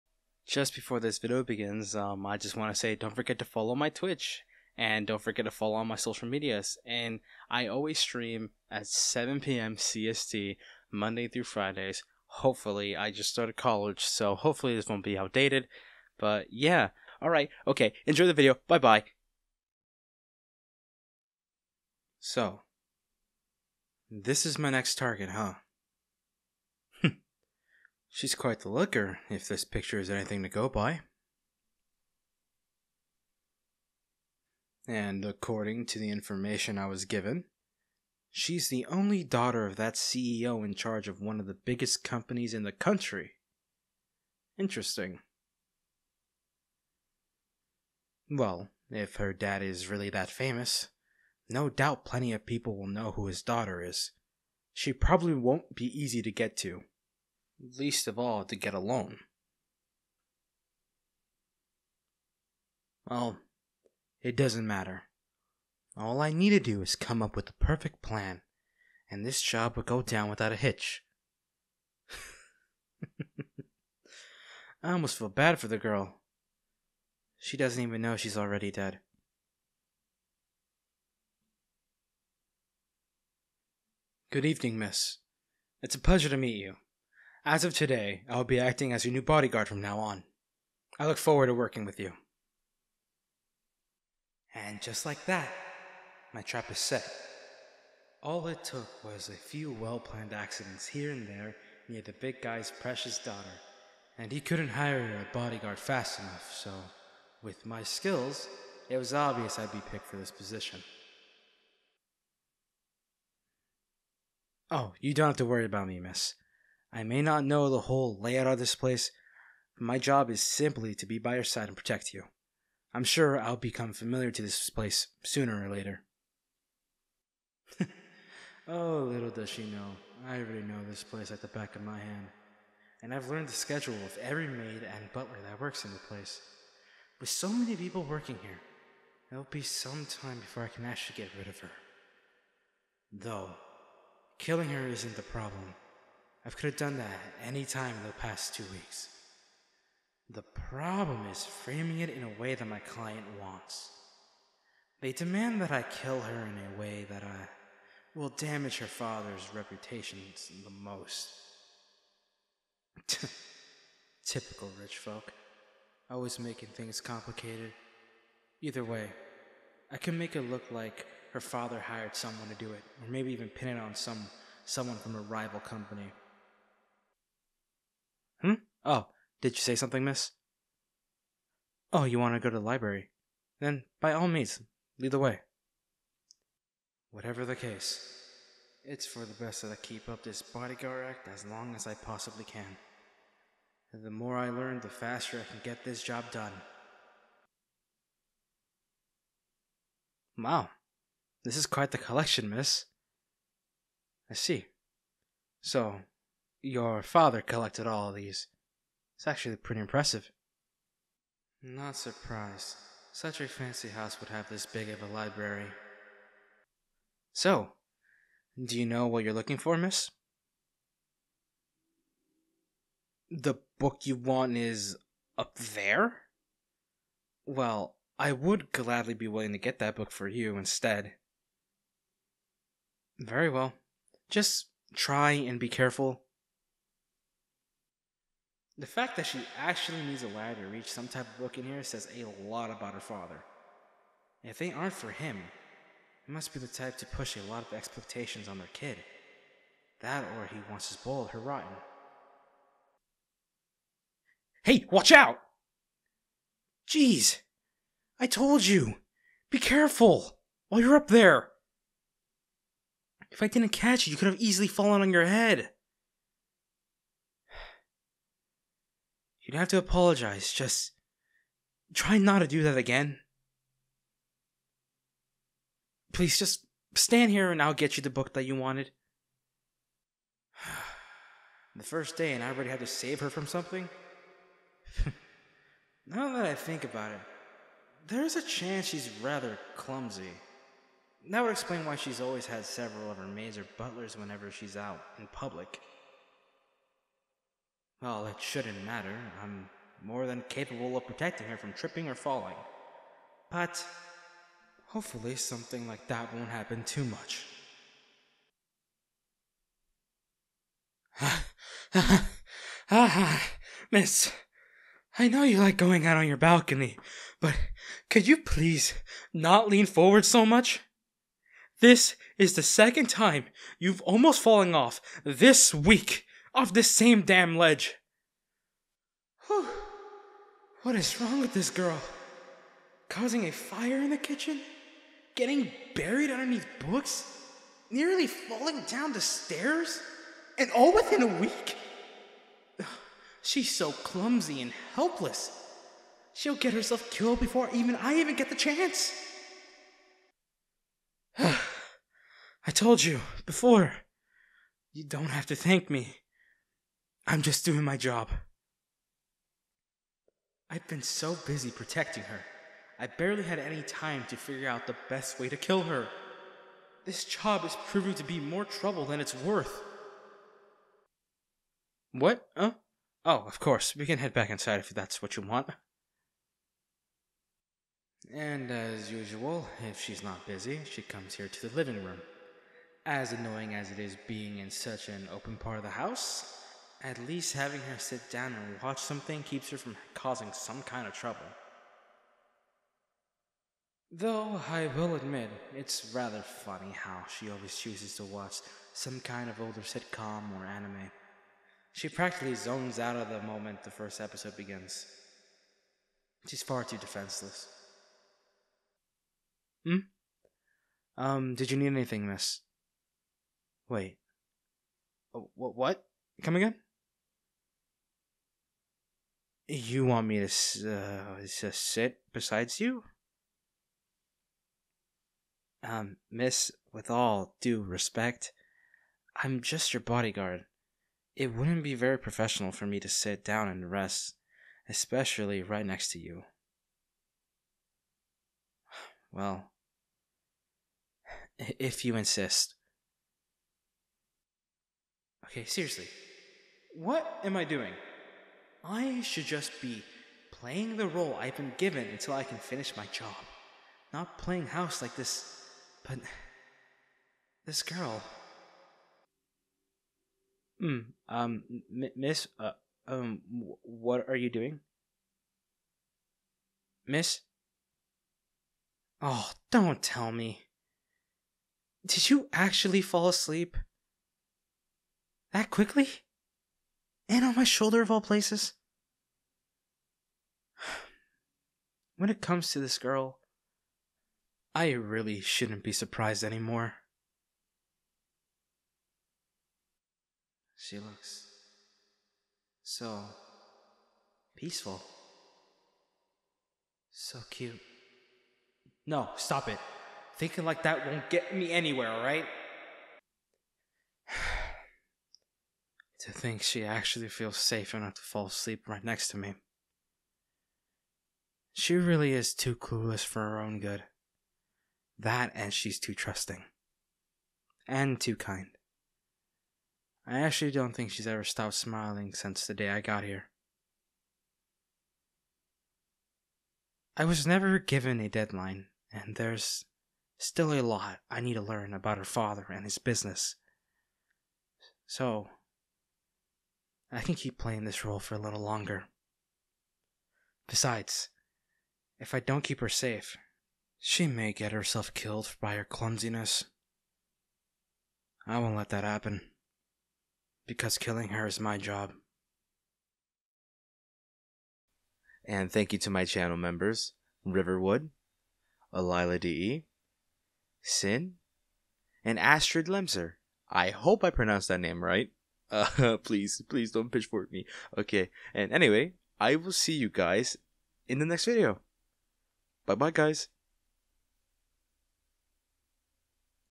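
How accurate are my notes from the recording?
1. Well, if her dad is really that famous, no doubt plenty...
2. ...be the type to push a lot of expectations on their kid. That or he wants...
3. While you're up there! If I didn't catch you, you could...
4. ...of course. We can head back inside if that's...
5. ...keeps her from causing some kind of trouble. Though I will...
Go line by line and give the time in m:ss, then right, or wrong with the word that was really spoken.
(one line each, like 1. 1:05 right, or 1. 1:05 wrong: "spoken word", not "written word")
1. 0:48 right
2. 4:06 right
3. 4:20 right
4. 6:13 right
5. 6:29 right.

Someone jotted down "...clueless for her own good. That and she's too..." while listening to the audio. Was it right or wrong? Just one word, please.
right.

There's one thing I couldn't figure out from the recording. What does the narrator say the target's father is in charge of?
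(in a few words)
One of the biggest companies in the country.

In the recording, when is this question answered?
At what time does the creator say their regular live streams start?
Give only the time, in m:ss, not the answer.
0:08.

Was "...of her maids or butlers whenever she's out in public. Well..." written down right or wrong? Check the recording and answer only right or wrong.
right.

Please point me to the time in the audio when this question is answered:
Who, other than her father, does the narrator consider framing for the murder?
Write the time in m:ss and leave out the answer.
2:55.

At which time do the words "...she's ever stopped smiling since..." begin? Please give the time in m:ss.
8:41.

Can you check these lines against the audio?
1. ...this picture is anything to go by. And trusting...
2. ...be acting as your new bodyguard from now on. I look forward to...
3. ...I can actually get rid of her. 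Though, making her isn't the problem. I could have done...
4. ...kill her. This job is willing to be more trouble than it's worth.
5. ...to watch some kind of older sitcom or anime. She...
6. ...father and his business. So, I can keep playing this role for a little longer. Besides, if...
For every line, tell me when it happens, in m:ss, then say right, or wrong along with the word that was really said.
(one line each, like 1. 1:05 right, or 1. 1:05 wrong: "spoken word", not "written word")
1. 0:29 wrong: "according", not "trusting"
2. 1:28 right
3. 2:20 wrong: "killing", not "making"
4. 6:05 wrong: "proving", not "willing"
5. 6:38 right
6. 8:52 right.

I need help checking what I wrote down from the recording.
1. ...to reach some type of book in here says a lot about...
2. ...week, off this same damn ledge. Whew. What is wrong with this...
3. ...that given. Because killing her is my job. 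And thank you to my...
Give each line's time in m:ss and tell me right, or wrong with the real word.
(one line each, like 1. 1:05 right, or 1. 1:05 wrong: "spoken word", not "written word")
1. 4:00 right
2. 5:25 right
3. 9:08 wrong: "happen", not "given".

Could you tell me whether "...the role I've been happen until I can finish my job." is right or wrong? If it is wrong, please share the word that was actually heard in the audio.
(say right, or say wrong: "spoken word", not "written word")
wrong: "given", not "happen".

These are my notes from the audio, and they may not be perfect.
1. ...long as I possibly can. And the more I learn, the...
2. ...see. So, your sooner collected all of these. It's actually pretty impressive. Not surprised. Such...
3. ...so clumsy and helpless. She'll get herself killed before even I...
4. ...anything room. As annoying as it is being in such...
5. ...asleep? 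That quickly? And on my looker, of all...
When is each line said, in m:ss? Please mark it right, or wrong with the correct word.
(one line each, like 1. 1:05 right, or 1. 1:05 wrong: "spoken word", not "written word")
1. 3:11 right
2. 3:24 wrong: "father", not "sooner"
3. 5:43 right
4. 6:21 wrong: "living", not "anything"
5. 7:53 wrong: "shoulder", not "looker".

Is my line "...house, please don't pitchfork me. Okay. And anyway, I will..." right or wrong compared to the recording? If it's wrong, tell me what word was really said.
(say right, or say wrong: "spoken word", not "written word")
wrong: "please", not "house".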